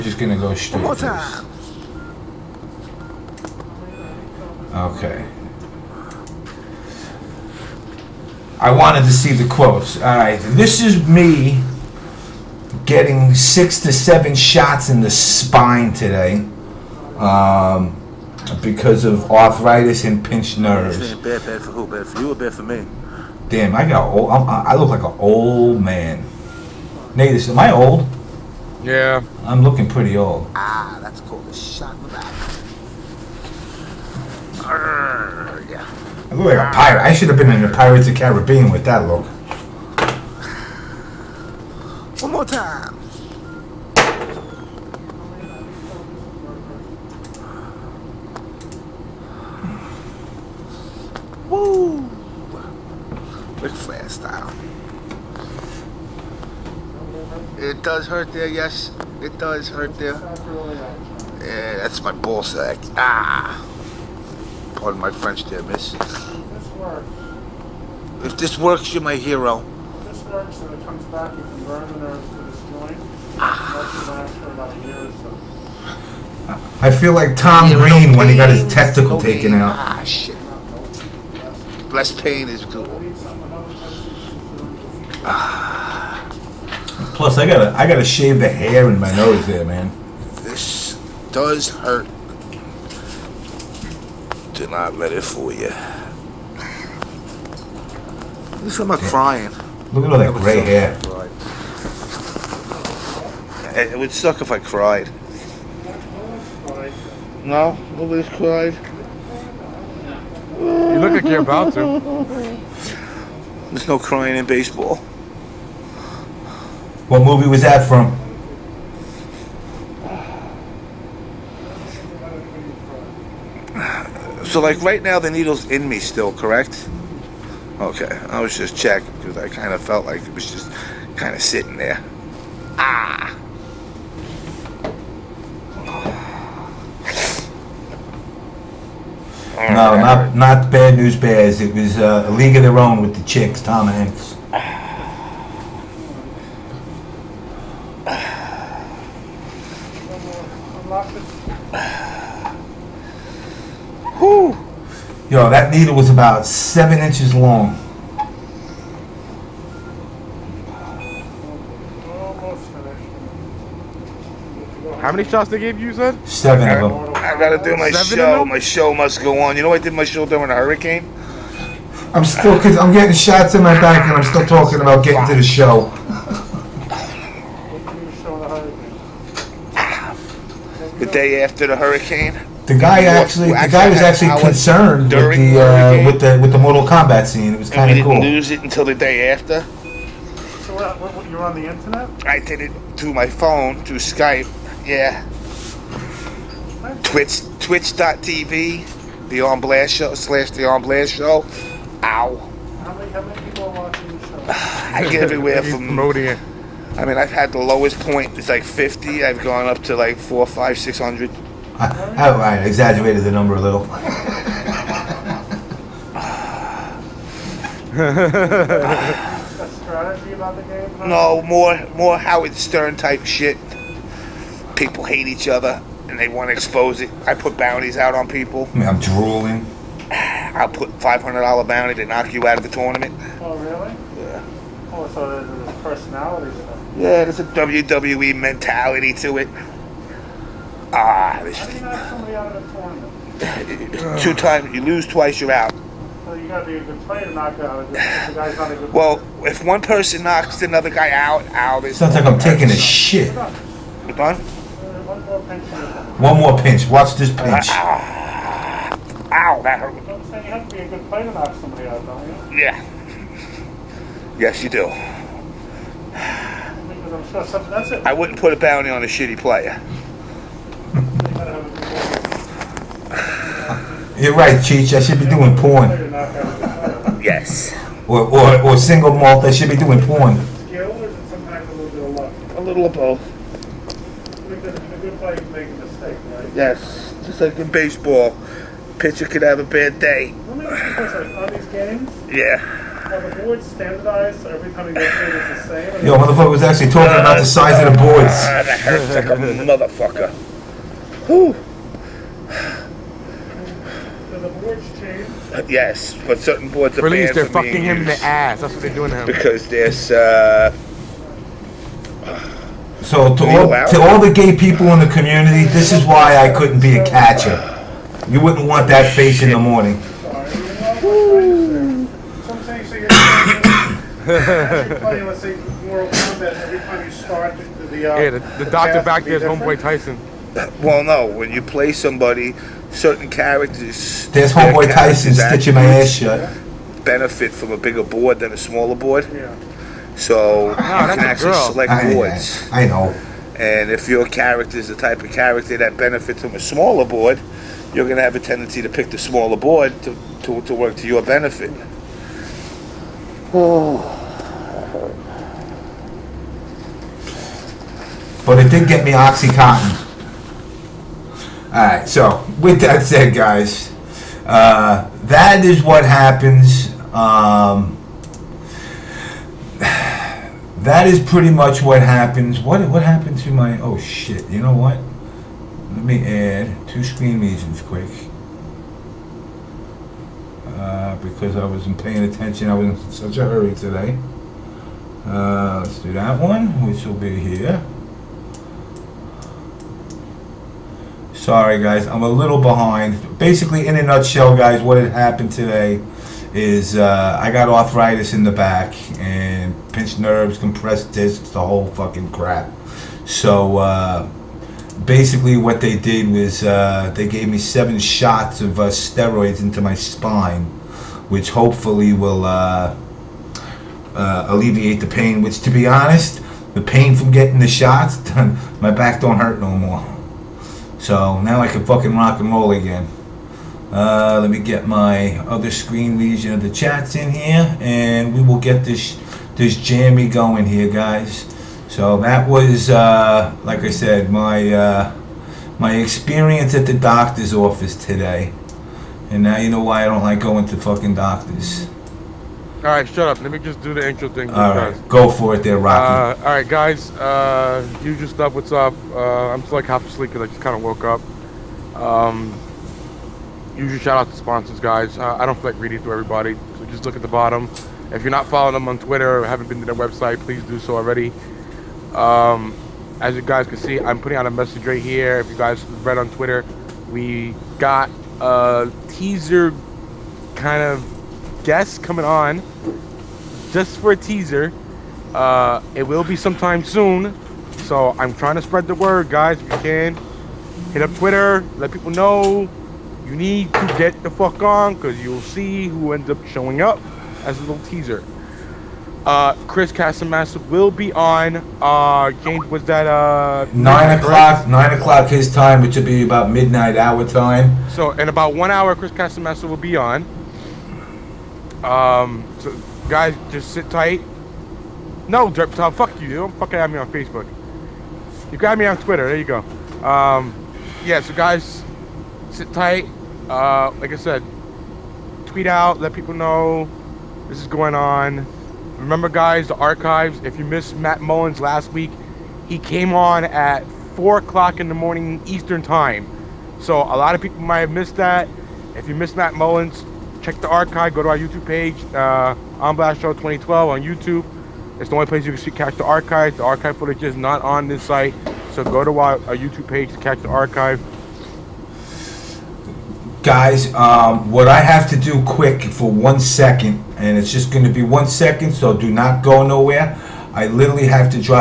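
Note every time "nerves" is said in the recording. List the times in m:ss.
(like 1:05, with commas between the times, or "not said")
0:20, 1:11, 6:40.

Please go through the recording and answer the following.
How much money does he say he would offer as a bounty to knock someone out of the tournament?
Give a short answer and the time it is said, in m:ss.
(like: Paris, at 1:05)
$500, at 3:50.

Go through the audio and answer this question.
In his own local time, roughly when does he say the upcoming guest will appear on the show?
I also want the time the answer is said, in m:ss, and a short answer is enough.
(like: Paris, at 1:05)
Midnight, at 8:16.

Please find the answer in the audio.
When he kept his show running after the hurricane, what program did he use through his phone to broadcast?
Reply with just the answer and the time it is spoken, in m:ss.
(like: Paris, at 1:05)
Skype, at 3:13.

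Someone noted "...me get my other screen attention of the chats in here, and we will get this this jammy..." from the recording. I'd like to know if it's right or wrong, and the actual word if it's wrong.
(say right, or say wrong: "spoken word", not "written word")
wrong: "region", not "attention".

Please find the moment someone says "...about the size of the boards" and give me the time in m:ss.
4:57.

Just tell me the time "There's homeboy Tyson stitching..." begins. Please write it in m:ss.
5:34.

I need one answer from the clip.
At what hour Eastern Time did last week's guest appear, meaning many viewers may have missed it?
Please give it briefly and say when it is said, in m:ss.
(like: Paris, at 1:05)
4 o'clock in the morning, at 8:44.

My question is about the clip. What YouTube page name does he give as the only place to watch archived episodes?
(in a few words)
On Blast Show 2012.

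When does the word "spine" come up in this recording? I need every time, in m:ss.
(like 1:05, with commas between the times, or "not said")
0:15, 6:49.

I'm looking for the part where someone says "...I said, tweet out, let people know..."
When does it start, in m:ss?
8:34.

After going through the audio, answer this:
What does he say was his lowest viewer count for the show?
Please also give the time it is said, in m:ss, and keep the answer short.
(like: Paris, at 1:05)
50, at 3:28.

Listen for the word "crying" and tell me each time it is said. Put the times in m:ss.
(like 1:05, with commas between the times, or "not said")
1:38, 1:53.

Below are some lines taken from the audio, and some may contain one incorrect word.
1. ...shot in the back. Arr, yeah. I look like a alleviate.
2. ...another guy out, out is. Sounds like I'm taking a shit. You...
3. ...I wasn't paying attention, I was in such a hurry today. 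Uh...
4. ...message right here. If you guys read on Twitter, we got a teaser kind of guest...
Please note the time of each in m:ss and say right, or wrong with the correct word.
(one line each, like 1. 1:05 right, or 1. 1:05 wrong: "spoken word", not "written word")
1. 0:31 wrong: "pirate", not "alleviate"
2. 4:10 right
3. 6:21 right
4. 7:44 right.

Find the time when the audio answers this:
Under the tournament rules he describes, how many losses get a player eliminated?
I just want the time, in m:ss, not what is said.
4:04.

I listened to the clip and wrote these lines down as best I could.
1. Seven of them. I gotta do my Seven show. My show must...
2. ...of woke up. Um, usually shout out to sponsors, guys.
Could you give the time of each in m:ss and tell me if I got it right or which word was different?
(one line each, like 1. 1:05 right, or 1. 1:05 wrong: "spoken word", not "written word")
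1. 2:46 right
2. 7:30 right.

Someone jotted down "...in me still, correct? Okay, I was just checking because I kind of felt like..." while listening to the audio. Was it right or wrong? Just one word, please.
right.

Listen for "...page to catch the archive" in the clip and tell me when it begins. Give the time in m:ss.
8:59.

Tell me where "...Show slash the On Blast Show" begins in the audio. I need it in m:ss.
3:19.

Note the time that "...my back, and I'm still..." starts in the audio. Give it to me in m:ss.
2:53.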